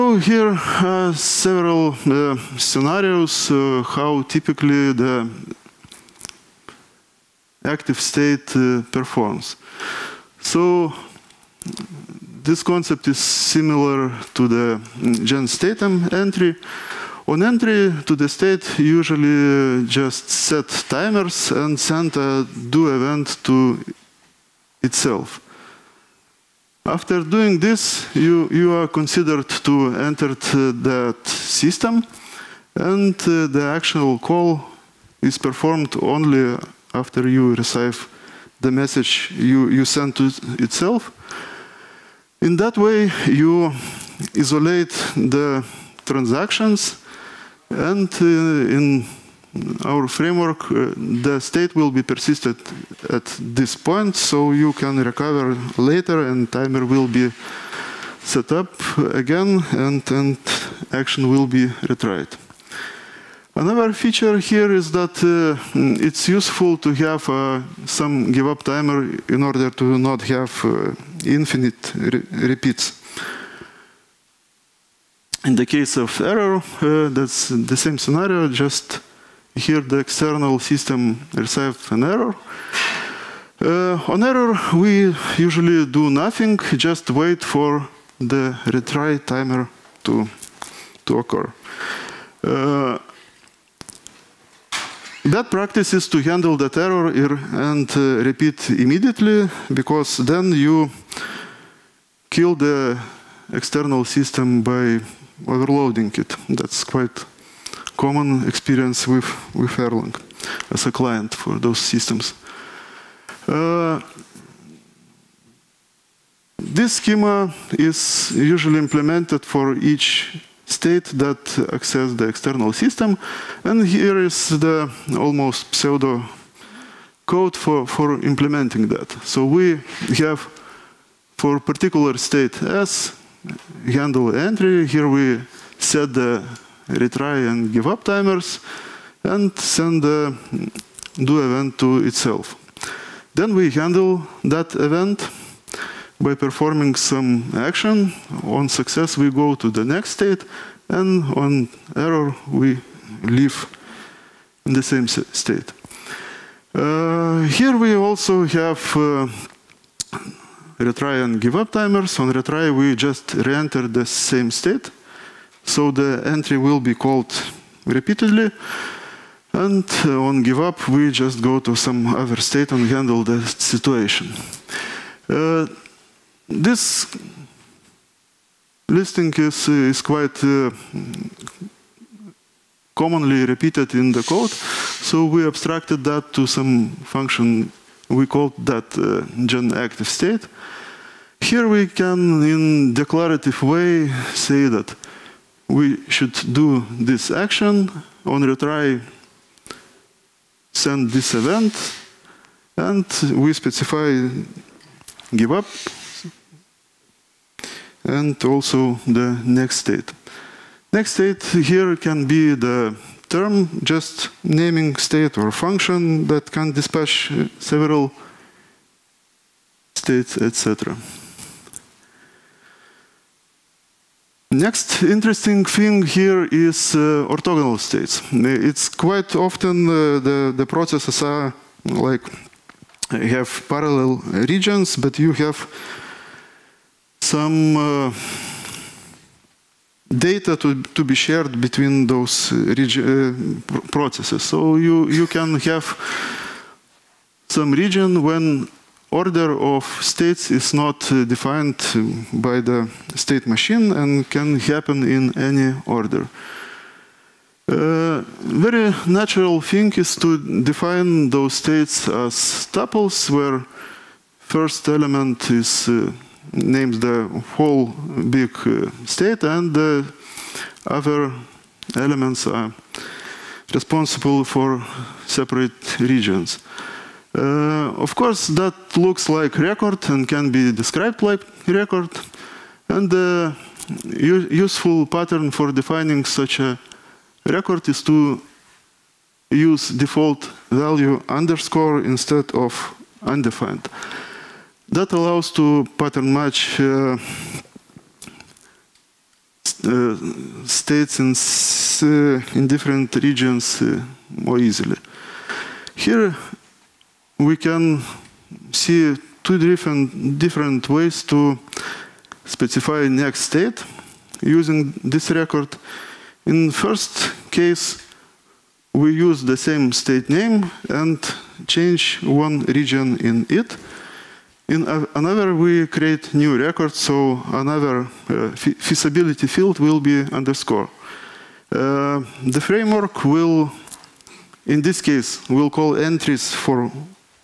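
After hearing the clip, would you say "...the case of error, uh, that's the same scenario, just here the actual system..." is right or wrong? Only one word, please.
wrong.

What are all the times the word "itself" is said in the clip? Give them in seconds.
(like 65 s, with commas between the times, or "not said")
24 s, 40 s, 142 s.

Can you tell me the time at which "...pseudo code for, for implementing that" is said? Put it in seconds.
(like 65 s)
125 s.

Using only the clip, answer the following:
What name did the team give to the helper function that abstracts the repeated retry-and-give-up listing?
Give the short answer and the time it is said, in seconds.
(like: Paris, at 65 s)
gen active state, at 189 s.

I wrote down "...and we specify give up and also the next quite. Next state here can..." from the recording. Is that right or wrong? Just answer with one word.
wrong.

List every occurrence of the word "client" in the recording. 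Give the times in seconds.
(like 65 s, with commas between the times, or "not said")
110 s.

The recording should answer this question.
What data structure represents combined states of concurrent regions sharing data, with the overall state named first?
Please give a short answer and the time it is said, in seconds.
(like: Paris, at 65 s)
tuples, at 262 s.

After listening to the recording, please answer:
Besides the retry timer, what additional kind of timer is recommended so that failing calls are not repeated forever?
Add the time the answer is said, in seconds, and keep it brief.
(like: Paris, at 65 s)
give up timer, at 68 s.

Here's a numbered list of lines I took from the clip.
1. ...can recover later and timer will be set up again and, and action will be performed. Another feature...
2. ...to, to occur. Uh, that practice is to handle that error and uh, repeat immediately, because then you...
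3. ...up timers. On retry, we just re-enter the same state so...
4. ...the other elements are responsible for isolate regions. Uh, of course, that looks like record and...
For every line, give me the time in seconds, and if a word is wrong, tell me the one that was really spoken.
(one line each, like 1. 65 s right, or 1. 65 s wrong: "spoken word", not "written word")
1. 54 s wrong: "retried", not "performed"
2. 90 s right
3. 161 s right
4. 269 s wrong: "separate", not "isolate".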